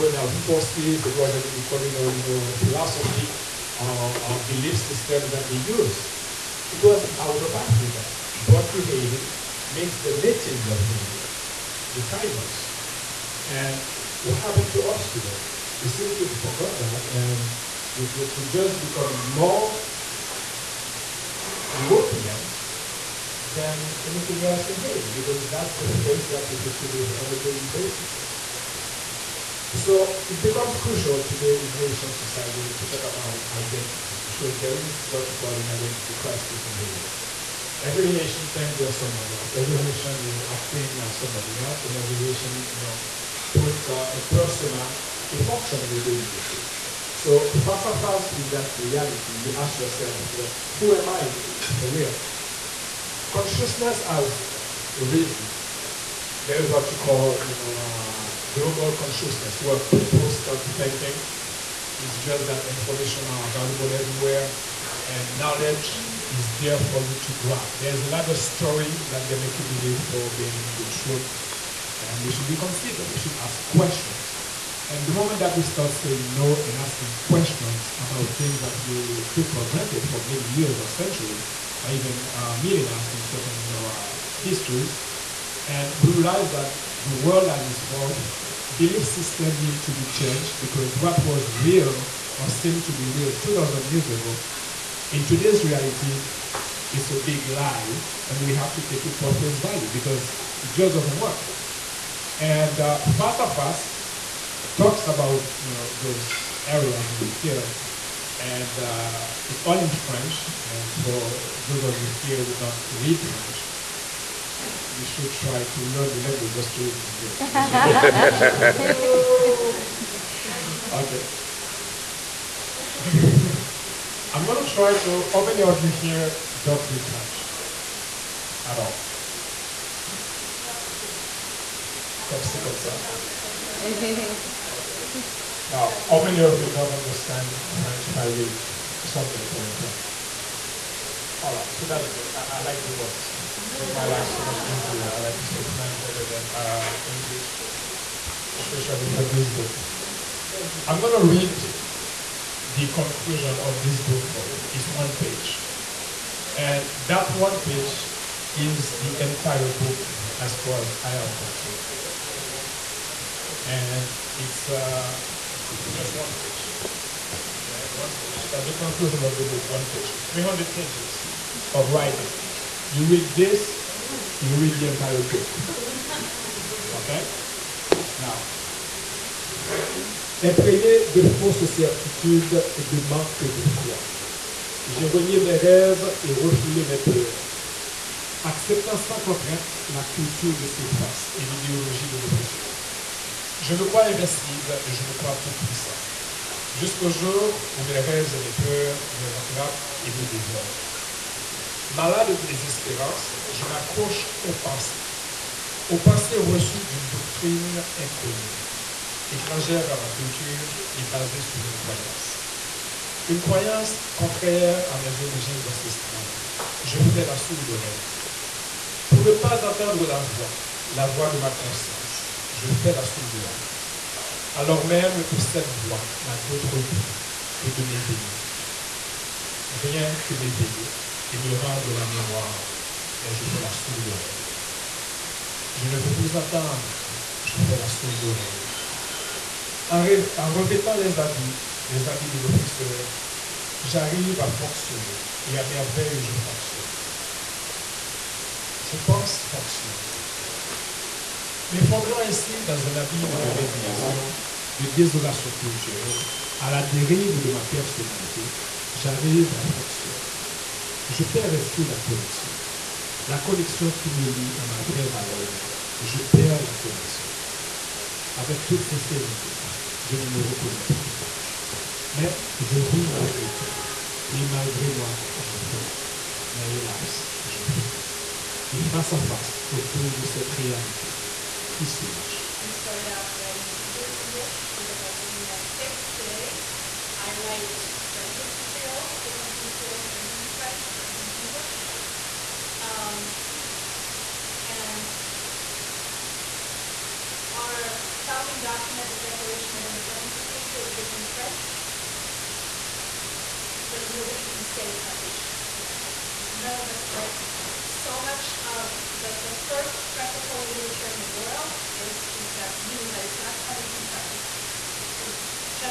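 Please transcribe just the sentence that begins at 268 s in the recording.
Avec toute sincérité, je ne me reconnais plus.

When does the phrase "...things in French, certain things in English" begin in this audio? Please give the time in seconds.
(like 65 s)
290 s.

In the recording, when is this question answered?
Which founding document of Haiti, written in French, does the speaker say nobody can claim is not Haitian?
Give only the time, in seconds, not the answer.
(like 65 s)
299 s.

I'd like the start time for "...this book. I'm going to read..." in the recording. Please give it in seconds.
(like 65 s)
149 s.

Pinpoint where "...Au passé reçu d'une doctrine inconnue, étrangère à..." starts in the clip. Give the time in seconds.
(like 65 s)
205 s.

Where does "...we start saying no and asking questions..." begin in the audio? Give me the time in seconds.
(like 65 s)
75 s.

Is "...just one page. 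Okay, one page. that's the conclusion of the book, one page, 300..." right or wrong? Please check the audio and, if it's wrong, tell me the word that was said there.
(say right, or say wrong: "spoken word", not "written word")
right.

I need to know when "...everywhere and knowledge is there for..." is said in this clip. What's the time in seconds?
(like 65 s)
63 s.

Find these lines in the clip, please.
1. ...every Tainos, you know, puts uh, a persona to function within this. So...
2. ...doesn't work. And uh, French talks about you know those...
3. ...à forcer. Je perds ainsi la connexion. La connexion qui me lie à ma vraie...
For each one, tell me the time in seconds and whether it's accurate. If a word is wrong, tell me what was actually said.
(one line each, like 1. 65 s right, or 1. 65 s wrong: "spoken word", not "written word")
1. 41 s wrong: "Haitian", not "Tainos"
2. 100 s wrong: "Fast", not "French"
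3. 259 s right.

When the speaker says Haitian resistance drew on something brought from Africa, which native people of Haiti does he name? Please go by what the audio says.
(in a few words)
Tainos.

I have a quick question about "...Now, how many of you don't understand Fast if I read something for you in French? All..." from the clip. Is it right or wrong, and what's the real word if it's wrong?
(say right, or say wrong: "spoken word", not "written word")
wrong: "French", not "Fast".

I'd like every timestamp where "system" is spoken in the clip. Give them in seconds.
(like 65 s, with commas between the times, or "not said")
4 s, 89 s.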